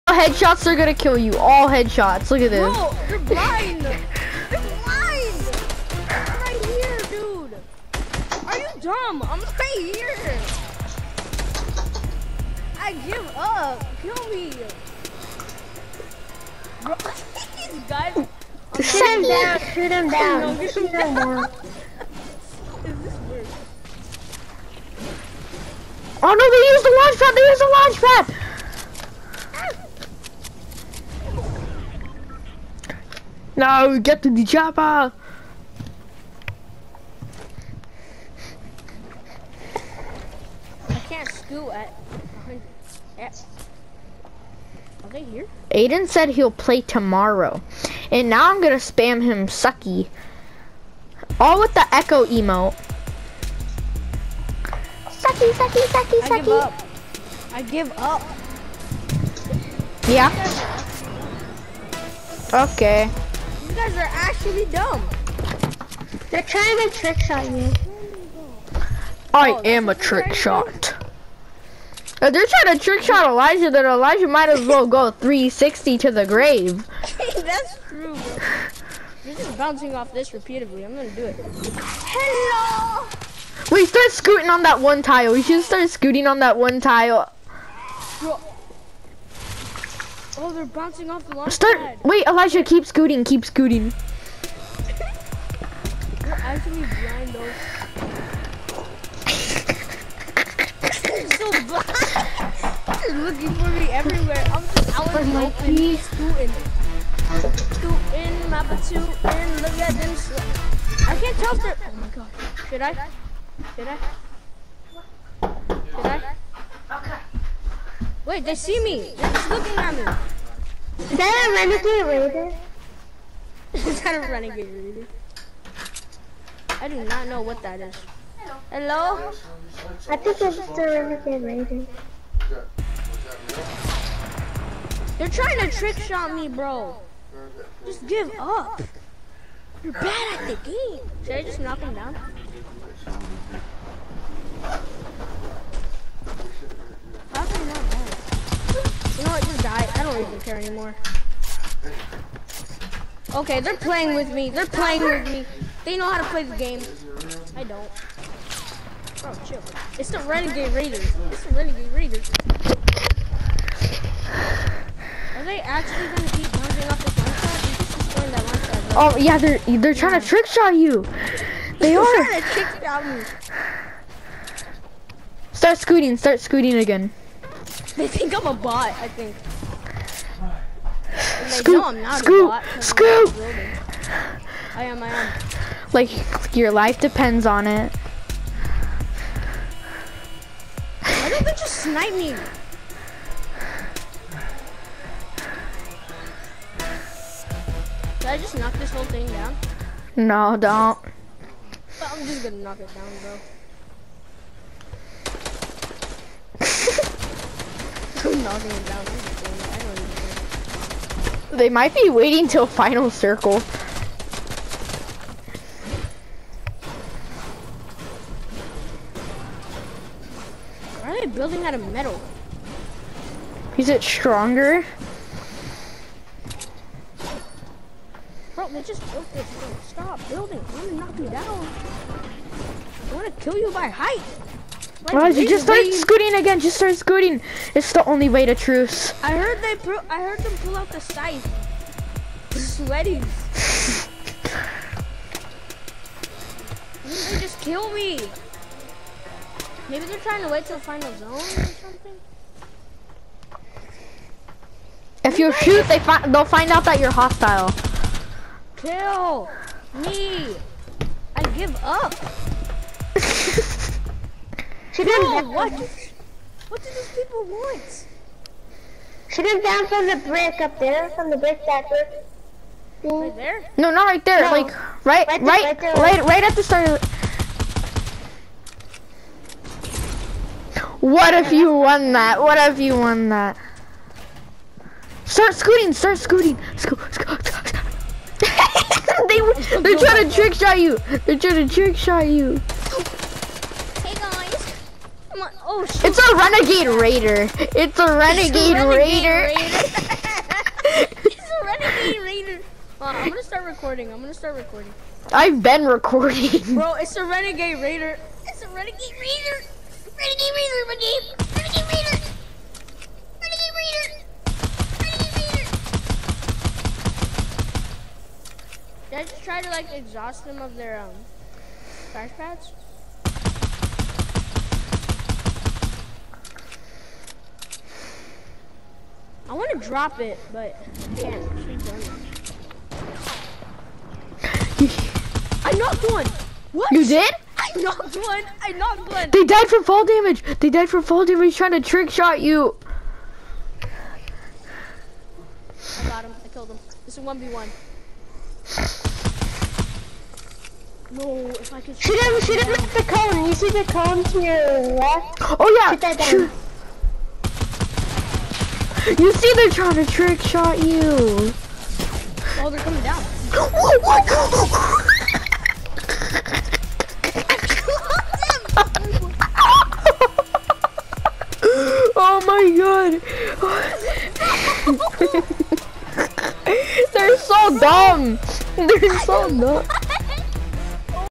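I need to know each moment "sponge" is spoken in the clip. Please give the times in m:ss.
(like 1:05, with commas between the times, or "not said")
not said.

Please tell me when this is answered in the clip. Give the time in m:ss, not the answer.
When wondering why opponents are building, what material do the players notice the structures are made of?
3:41.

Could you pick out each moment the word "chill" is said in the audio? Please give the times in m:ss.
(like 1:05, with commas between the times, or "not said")
2:39.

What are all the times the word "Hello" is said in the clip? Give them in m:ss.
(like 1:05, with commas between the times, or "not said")
1:21, 2:08.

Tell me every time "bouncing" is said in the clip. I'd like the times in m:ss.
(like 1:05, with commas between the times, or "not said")
1:19, 1:30, 2:46.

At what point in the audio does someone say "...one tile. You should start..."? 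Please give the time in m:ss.
1:24.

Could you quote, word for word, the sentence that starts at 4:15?
If you shoot, they fi they'll find out that you're hostile.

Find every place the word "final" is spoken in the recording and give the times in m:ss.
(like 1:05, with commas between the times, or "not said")
3:32, 4:10.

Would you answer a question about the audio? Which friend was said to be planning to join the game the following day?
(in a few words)
Aiden.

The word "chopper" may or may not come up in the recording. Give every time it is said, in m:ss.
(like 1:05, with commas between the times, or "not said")
0:34.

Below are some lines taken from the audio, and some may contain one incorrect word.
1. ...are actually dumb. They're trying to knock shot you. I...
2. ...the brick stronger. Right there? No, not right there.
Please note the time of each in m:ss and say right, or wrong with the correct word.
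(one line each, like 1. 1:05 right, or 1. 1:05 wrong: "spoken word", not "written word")
1. 1:03 wrong: "trick", not "knock"
2. 4:31 wrong: "backer", not "stronger".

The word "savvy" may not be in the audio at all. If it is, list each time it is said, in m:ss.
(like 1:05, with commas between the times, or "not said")
not said.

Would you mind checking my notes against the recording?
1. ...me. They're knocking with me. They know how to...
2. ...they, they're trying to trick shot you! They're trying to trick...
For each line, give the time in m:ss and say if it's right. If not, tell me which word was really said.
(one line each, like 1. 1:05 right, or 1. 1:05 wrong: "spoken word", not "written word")
1. 2:34 wrong: "playing", not "knocking"
2. 4:49 right.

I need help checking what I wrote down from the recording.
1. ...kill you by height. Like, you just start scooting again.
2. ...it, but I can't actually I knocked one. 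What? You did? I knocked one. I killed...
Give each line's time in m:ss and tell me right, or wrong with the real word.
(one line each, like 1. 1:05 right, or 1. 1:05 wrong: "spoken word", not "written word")
1. 3:53 right
2. 5:30 wrong: "knocked", not "killed".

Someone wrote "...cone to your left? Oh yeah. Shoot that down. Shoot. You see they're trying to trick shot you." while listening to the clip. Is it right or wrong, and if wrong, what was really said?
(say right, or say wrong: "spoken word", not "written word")
right.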